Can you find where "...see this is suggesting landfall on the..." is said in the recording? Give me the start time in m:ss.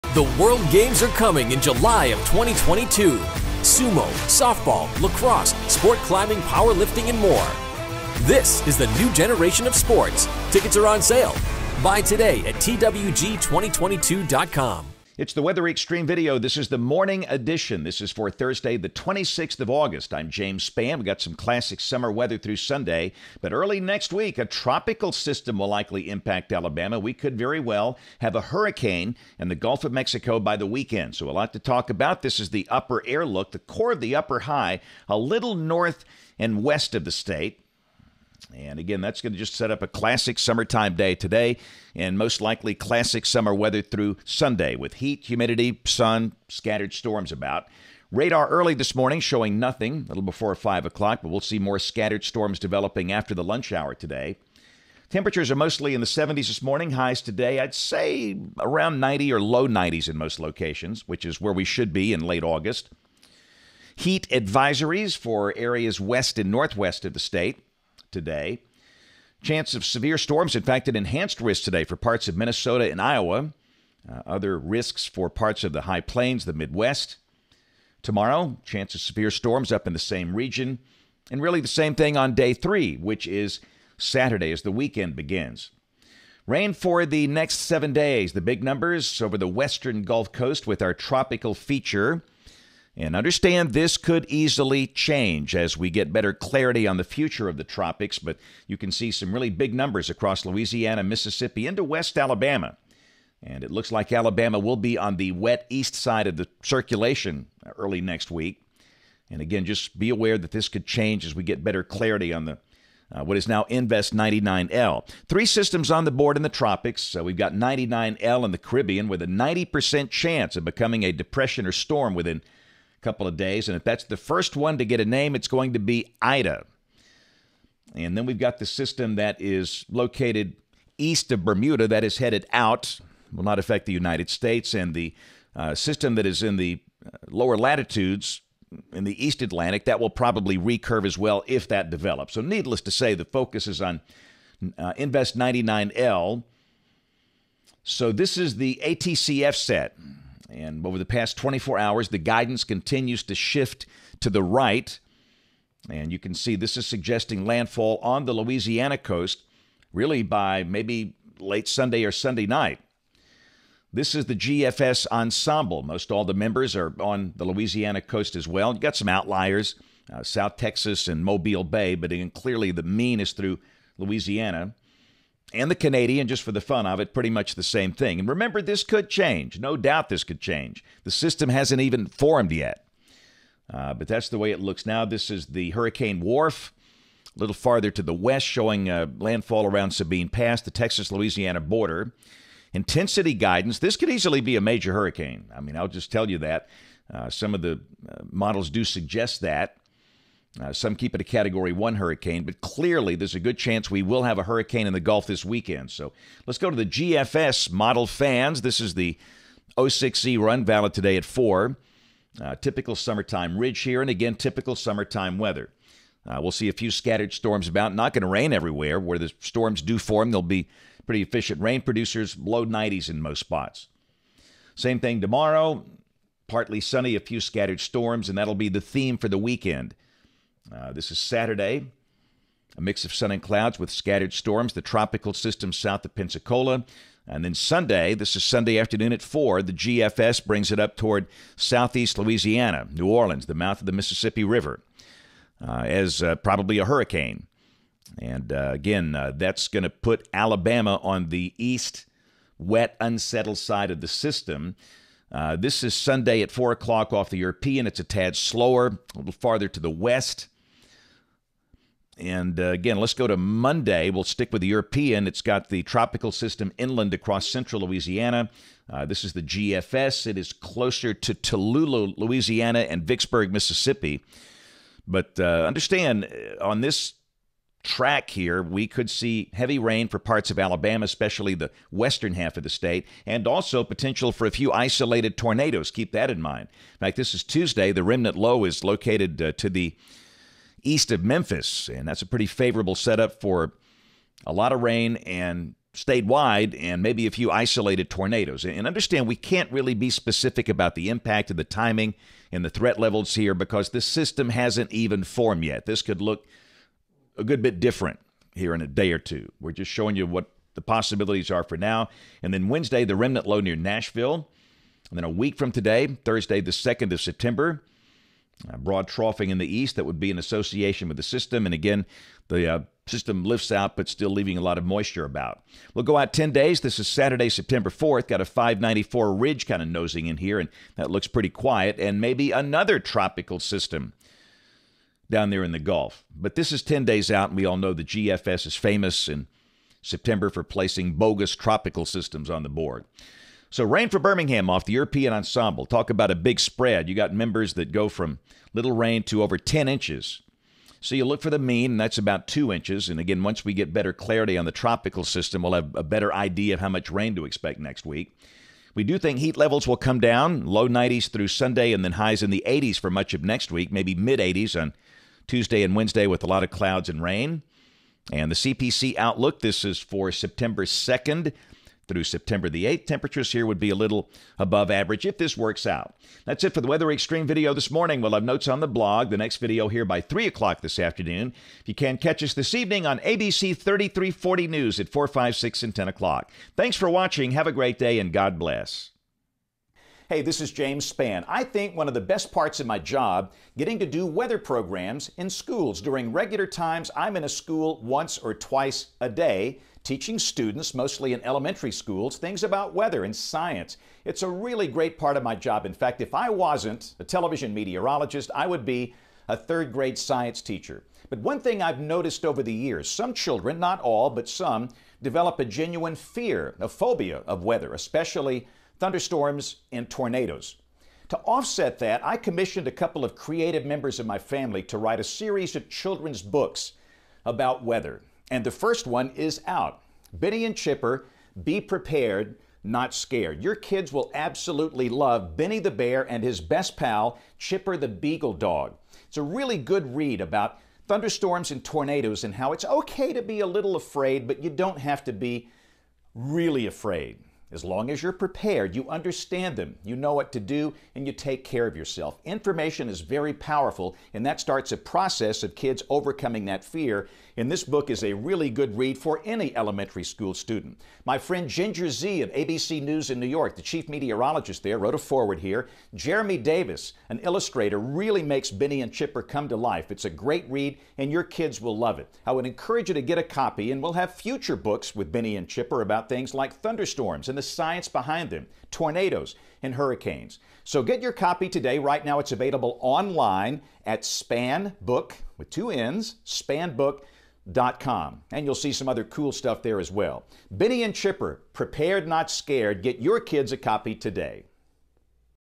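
2:36.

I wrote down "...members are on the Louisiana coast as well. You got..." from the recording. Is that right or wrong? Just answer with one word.
right.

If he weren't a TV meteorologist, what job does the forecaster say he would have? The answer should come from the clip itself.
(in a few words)
third grade science teacher.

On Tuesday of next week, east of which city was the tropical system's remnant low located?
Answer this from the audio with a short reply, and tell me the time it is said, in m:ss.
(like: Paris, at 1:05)
Memphis, at 4:51.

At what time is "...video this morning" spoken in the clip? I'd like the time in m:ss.
6:17.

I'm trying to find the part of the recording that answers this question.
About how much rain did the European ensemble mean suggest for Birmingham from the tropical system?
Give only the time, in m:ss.
5:52.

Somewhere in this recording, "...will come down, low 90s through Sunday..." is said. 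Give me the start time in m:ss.
5:59.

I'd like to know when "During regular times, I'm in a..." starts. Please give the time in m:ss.
6:36.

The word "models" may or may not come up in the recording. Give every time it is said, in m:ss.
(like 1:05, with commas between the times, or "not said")
3:18, 3:27.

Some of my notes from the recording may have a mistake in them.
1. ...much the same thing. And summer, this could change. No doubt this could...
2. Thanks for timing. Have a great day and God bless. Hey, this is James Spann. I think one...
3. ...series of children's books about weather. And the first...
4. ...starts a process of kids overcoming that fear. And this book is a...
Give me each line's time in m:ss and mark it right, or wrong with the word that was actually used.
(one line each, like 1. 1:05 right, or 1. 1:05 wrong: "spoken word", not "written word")
1. 2:57 wrong: "remember", not "summer"
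2. 6:26 wrong: "watching", not "timing"
3. 7:05 right
4. 7:34 right.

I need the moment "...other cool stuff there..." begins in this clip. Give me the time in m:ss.
8:09.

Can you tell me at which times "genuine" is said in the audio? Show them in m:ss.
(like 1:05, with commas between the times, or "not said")
6:55.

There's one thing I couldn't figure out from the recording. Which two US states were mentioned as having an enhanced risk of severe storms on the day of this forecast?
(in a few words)
Minnesota and Iowa.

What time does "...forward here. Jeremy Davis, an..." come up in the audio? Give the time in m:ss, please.
7:45.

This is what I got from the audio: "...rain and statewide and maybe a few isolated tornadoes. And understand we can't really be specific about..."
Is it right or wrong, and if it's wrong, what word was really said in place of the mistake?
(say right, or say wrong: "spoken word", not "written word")
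right.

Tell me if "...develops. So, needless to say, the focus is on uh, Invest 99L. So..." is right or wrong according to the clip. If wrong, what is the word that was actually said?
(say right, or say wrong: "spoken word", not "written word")
right.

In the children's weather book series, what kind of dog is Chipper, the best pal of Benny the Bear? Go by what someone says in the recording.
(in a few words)
Beagle.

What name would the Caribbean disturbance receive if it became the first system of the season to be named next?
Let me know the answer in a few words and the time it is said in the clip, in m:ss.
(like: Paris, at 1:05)
Ida, at 2:06.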